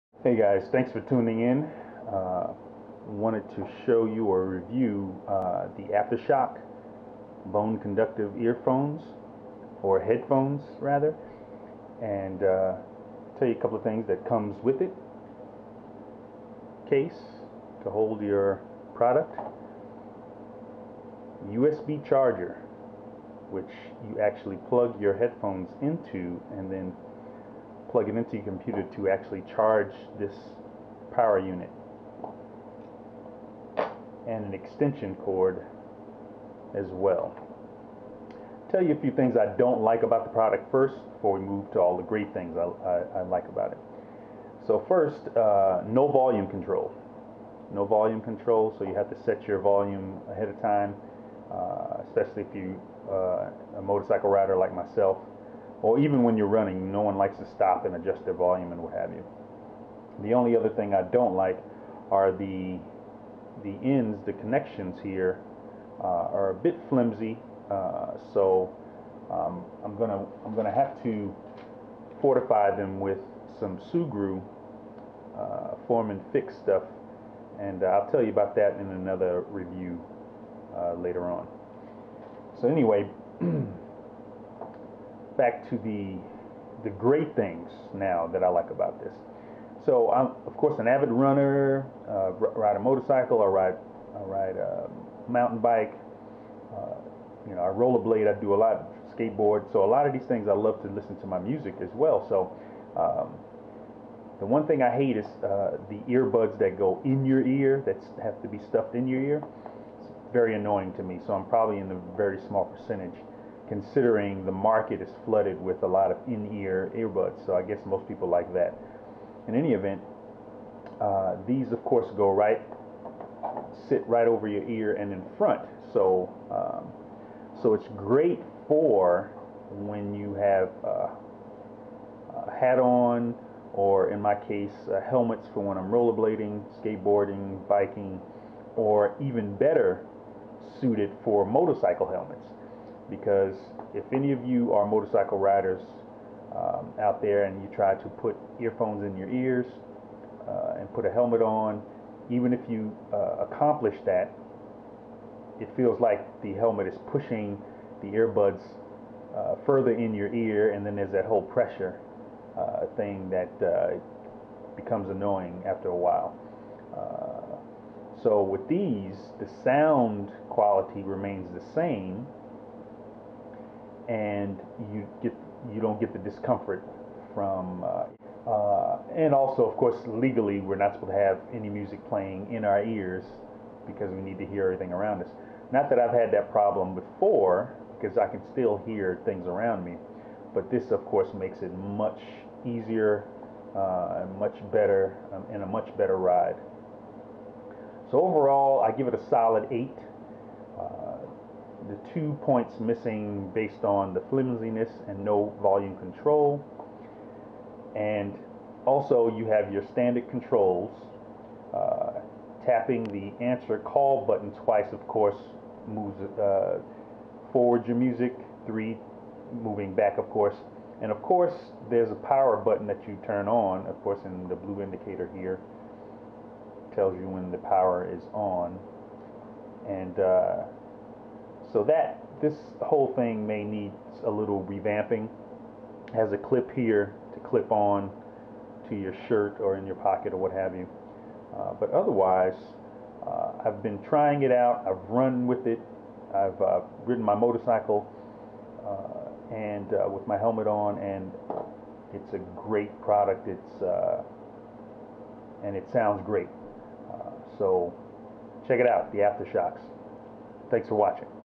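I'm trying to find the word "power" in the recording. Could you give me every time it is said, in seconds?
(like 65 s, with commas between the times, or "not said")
31 s, 222 s, 227 s.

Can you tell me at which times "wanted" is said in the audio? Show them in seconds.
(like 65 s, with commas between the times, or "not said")
3 s.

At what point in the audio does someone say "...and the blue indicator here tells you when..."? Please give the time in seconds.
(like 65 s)
224 s.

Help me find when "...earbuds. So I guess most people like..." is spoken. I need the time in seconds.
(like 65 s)
116 s.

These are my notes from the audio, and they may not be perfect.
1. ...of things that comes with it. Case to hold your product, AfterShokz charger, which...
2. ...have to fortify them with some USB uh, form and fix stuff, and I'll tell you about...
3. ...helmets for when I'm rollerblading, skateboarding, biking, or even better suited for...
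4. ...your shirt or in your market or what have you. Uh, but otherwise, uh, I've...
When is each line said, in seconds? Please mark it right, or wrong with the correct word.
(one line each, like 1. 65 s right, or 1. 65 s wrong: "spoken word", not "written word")
1. 13 s wrong: "USB", not "AfterShokz"
2. 70 s wrong: "Sugru", not "USB"
3. 135 s right
4. 238 s wrong: "pocket", not "market".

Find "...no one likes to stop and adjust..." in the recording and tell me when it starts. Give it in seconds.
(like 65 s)
56 s.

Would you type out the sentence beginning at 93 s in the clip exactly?
I ride I ride a mountain bike.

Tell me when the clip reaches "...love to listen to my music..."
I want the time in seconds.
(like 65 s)
100 s.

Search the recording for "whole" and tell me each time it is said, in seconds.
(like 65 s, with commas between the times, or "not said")
161 s, 232 s.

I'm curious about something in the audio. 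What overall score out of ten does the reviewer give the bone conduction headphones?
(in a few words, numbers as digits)
8.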